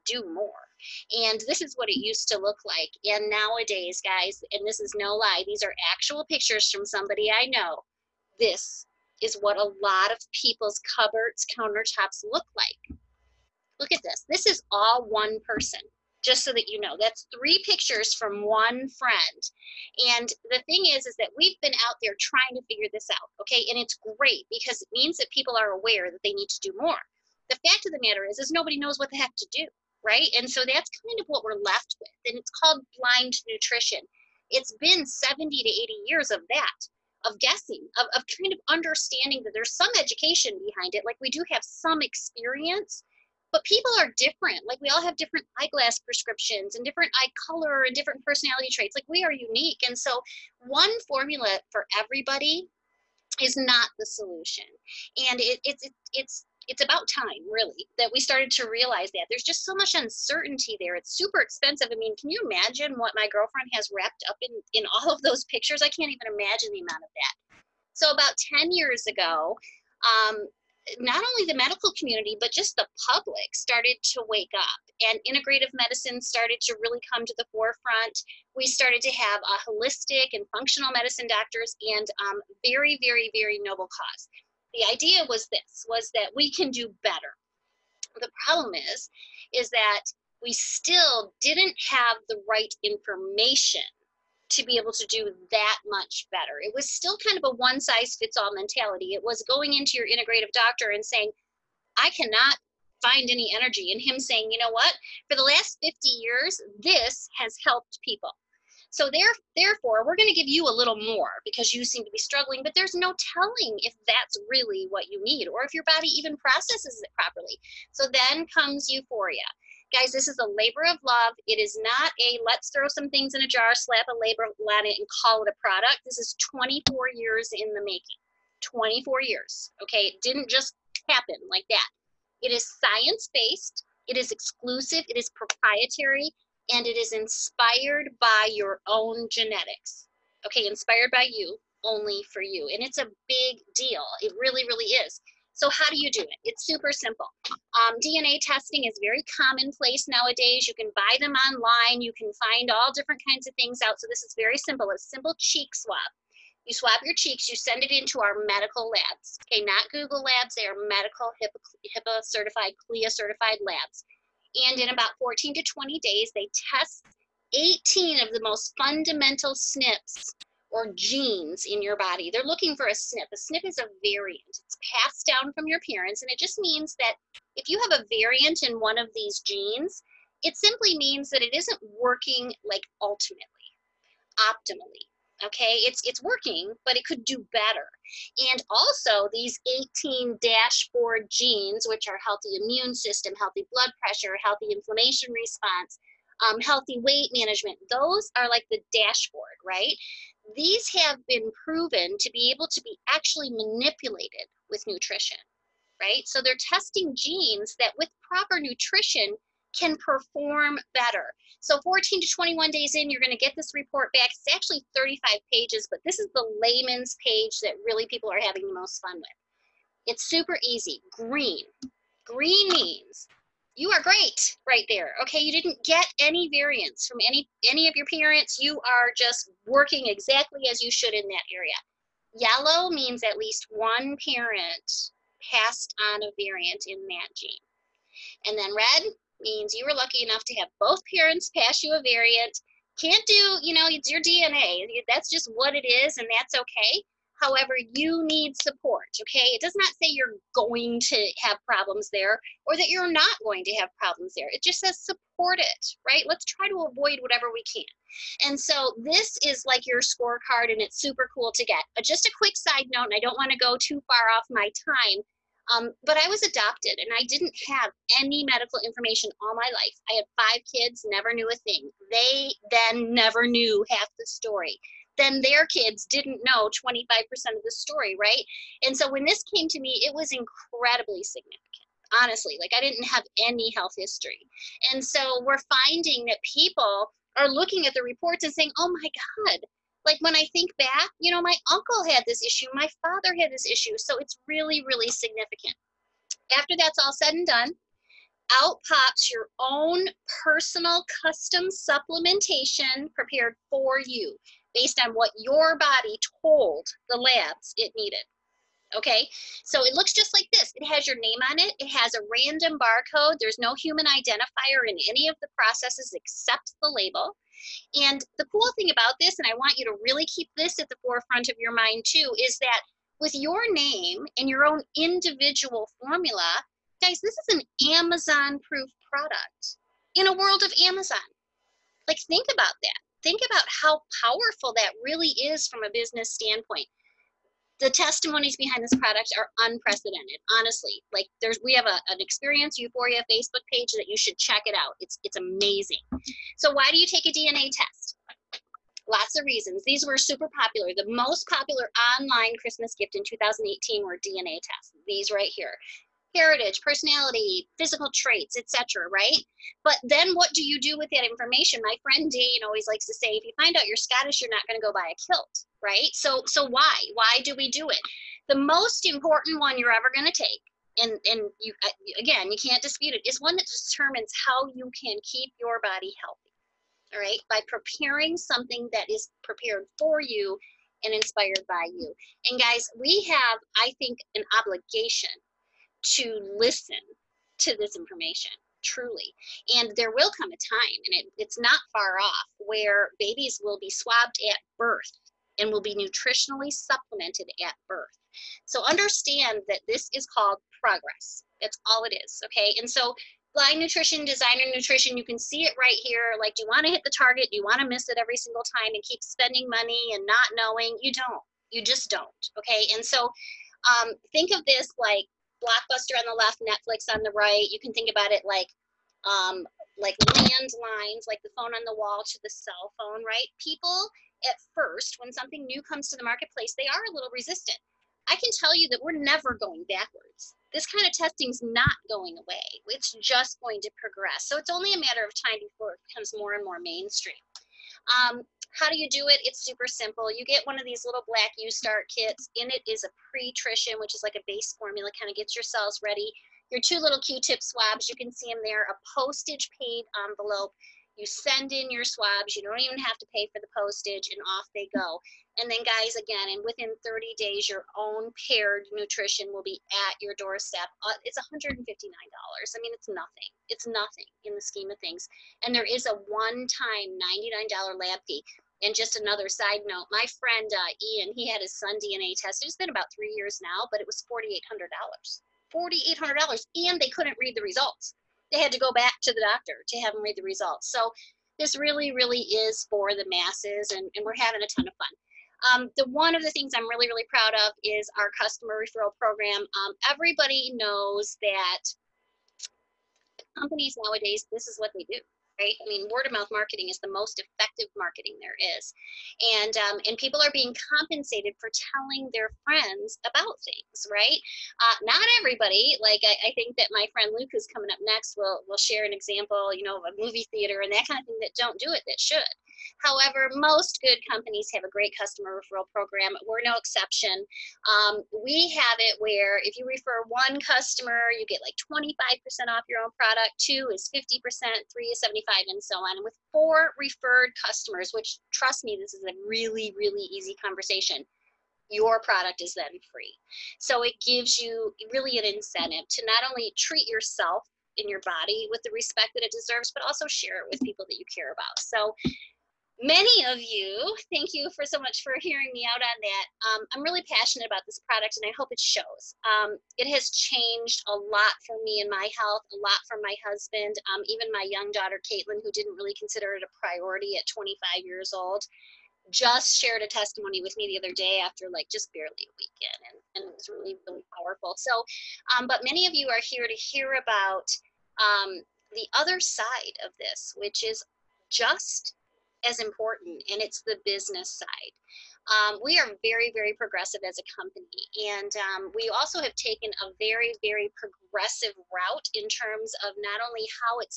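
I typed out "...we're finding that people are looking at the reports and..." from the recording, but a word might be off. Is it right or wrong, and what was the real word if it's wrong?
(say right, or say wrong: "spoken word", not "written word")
right.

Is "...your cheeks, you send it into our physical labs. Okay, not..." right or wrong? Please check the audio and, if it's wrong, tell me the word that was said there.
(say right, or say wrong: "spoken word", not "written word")
wrong: "medical", not "physical".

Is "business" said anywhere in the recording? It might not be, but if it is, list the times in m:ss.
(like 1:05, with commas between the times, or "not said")
5:35, 9:34.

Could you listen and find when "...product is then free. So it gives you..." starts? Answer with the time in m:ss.
8:52.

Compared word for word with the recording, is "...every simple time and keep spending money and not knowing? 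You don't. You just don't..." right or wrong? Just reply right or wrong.
wrong.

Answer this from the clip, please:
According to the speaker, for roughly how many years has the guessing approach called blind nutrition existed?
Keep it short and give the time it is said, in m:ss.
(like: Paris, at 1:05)
70 to 80 years, at 0:35.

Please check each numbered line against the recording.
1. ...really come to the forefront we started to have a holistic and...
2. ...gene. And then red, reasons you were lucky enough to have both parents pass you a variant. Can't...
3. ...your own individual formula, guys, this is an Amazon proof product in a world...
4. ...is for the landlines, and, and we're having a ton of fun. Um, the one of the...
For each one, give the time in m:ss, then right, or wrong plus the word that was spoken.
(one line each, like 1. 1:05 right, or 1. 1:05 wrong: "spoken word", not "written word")
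1. 1:16 right
2. 3:57 wrong: "means", not "reasons"
3. 5:24 right
4. 8:02 wrong: "masses", not "landlines".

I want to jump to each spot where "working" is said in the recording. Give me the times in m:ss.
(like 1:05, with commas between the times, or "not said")
3:01, 3:06, 3:49.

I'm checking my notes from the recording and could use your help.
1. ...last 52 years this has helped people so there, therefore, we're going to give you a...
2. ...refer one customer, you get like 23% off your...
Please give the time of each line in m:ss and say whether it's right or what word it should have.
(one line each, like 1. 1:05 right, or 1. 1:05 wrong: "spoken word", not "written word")
1. 1:45 wrong: "50", not "52"
2. 8:39 wrong: "25", not "23".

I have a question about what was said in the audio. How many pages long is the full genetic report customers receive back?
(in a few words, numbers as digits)
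35 pages.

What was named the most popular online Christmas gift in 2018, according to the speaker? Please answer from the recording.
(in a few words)
DNA tests.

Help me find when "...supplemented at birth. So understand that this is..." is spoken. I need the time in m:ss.
6:36.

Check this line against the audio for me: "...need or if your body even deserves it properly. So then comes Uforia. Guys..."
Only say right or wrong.
wrong.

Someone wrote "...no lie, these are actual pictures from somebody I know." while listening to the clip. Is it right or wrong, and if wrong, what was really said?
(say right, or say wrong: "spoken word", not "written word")
right.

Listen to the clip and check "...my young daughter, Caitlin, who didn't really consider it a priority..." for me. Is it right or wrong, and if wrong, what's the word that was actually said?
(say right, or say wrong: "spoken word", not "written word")
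right.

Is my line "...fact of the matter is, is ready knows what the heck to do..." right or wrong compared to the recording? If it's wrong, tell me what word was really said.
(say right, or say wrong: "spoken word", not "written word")
wrong: "nobody", not "ready".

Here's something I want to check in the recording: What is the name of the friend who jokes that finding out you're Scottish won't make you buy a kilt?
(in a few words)
Dane.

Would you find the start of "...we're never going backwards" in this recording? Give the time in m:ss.
7:09.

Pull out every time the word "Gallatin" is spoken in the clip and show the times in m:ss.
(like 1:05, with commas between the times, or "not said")
not said.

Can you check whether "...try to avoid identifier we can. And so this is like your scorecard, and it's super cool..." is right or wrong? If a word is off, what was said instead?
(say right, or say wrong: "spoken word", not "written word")
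wrong: "whatever", not "identifier".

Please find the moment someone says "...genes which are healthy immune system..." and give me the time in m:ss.
3:11.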